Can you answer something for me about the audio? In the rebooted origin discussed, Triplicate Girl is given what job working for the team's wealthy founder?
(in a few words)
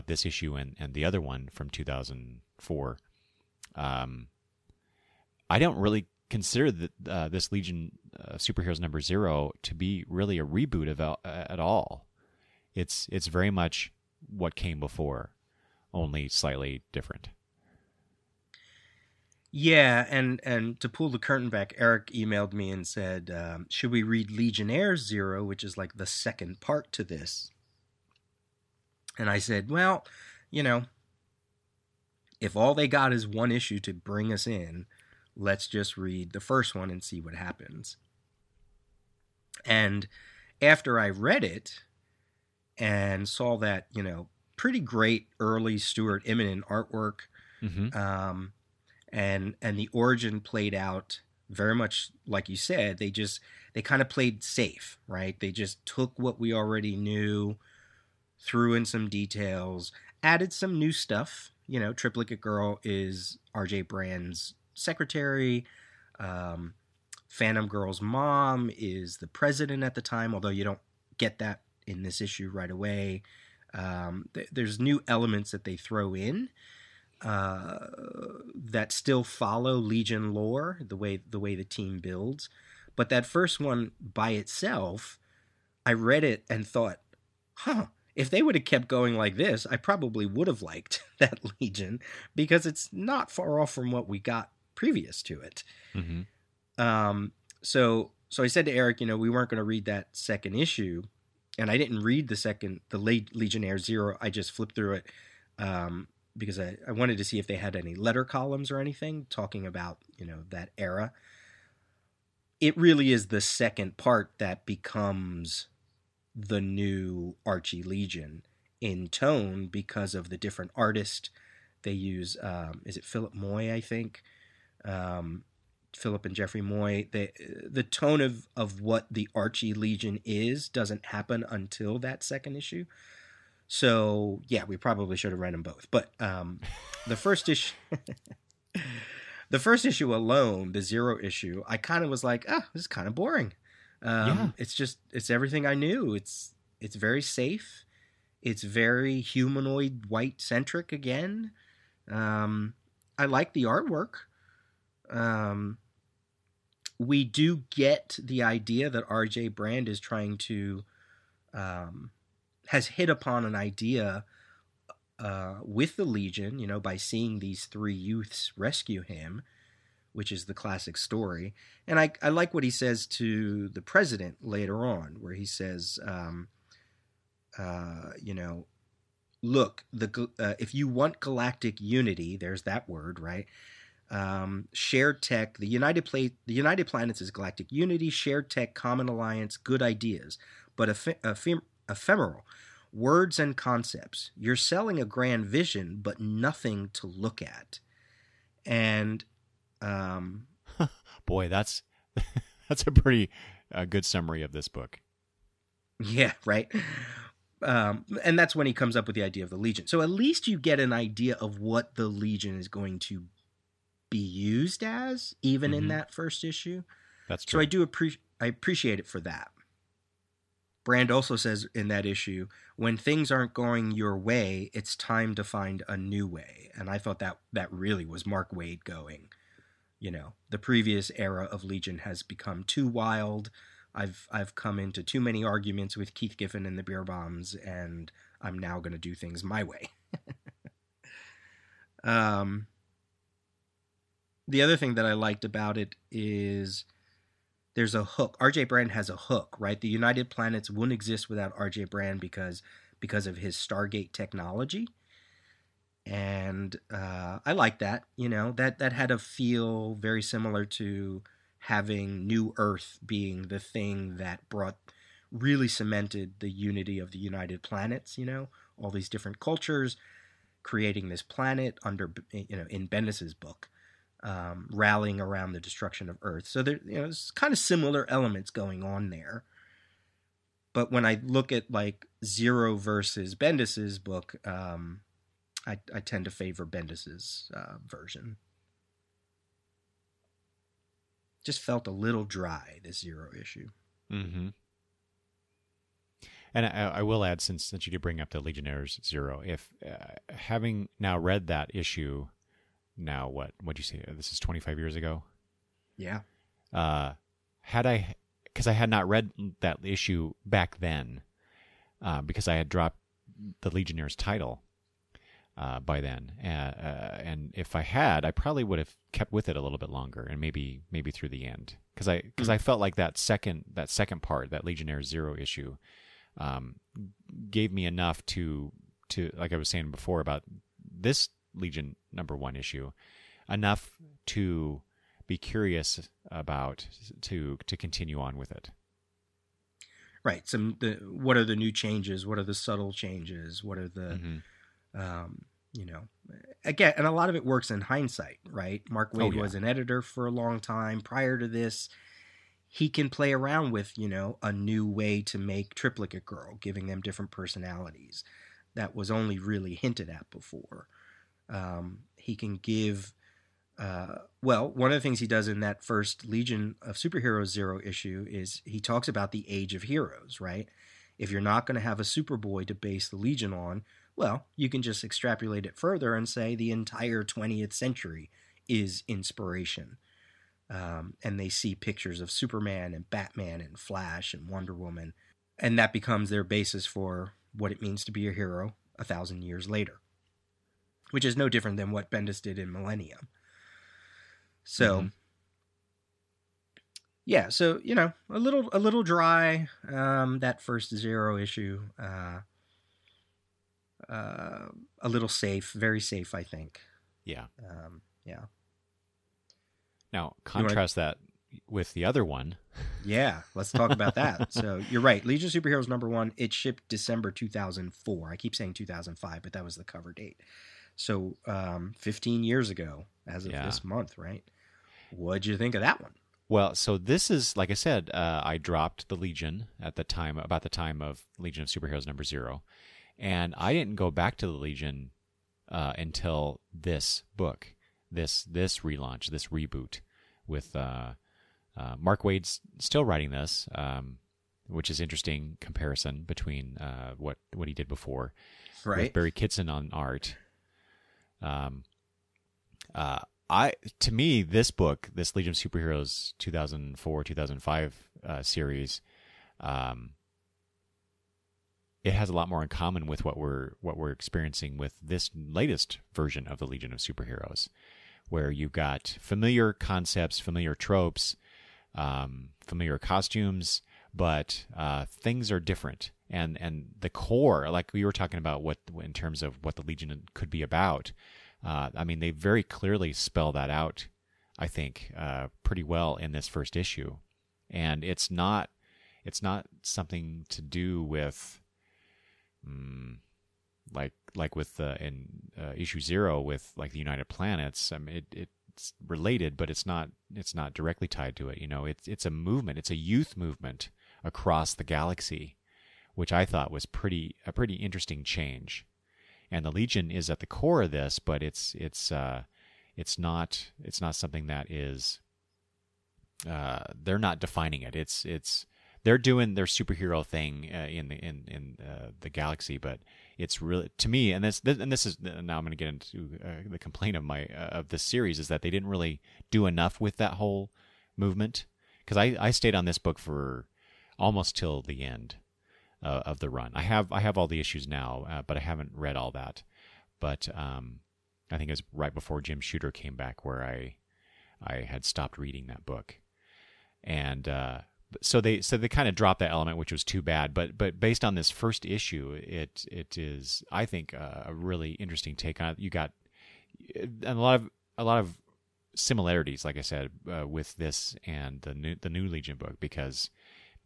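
Secretary.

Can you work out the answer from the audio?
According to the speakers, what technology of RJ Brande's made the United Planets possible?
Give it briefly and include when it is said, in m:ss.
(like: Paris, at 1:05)
Stargate technology, at 4:13.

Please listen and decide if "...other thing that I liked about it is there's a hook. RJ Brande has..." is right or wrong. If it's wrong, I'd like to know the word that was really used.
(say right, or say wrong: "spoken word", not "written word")
right.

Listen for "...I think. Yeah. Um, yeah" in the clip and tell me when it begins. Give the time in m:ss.
6:46.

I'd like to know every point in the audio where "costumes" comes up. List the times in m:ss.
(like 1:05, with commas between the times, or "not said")
7:52.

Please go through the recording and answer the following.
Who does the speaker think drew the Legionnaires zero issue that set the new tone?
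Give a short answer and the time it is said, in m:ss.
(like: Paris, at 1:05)
Philip and Jeffrey Moy, at 2:05.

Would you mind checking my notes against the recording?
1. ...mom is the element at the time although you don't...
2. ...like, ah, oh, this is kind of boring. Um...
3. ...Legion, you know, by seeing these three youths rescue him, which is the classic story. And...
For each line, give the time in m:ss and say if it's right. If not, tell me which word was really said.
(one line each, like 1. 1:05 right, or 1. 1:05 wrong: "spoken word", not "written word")
1. 1:08 wrong: "president", not "element"
2. 2:22 right
3. 2:46 right.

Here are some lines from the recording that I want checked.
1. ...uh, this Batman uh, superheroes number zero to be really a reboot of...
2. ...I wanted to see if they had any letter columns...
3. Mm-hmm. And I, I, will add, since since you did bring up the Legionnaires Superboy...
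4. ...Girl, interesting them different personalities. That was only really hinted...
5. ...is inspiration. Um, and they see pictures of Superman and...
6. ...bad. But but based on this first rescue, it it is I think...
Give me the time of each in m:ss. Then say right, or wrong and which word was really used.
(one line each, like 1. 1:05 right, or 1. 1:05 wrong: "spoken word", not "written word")
1. 0:07 wrong: "Legion", not "Batman"
2. 1:46 right
3. 4:54 wrong: "Zero", not "Superboy"
4. 5:56 wrong: "giving", not "interesting"
5. 6:18 right
6. 9:10 wrong: "issue", not "rescue".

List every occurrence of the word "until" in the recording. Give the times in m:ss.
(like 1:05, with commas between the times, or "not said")
2:11, 7:15.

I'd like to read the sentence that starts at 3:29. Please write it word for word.
So at least you get an idea of what the legion is going to be used as, even mm-hmm.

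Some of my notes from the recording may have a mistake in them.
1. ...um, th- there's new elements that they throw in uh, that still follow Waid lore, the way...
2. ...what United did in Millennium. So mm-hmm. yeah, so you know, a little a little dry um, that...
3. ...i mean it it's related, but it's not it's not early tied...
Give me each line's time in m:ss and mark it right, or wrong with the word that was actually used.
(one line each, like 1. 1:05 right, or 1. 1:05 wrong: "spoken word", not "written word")
1. 1:13 wrong: "Legion", not "Waid"
2. 6:31 wrong: "Bendis", not "United"
3. 8:17 wrong: "directly", not "early".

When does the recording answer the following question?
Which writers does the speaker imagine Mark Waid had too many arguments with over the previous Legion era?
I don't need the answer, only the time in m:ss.
3:56.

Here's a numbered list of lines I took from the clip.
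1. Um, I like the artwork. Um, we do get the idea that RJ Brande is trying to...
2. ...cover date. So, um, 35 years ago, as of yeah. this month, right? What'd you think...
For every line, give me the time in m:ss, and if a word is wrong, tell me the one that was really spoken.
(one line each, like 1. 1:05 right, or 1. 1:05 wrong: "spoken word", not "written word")
1. 2:32 right
2. 6:59 wrong: "15", not "35".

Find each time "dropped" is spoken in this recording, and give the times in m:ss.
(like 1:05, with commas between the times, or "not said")
5:12, 7:08, 9:09.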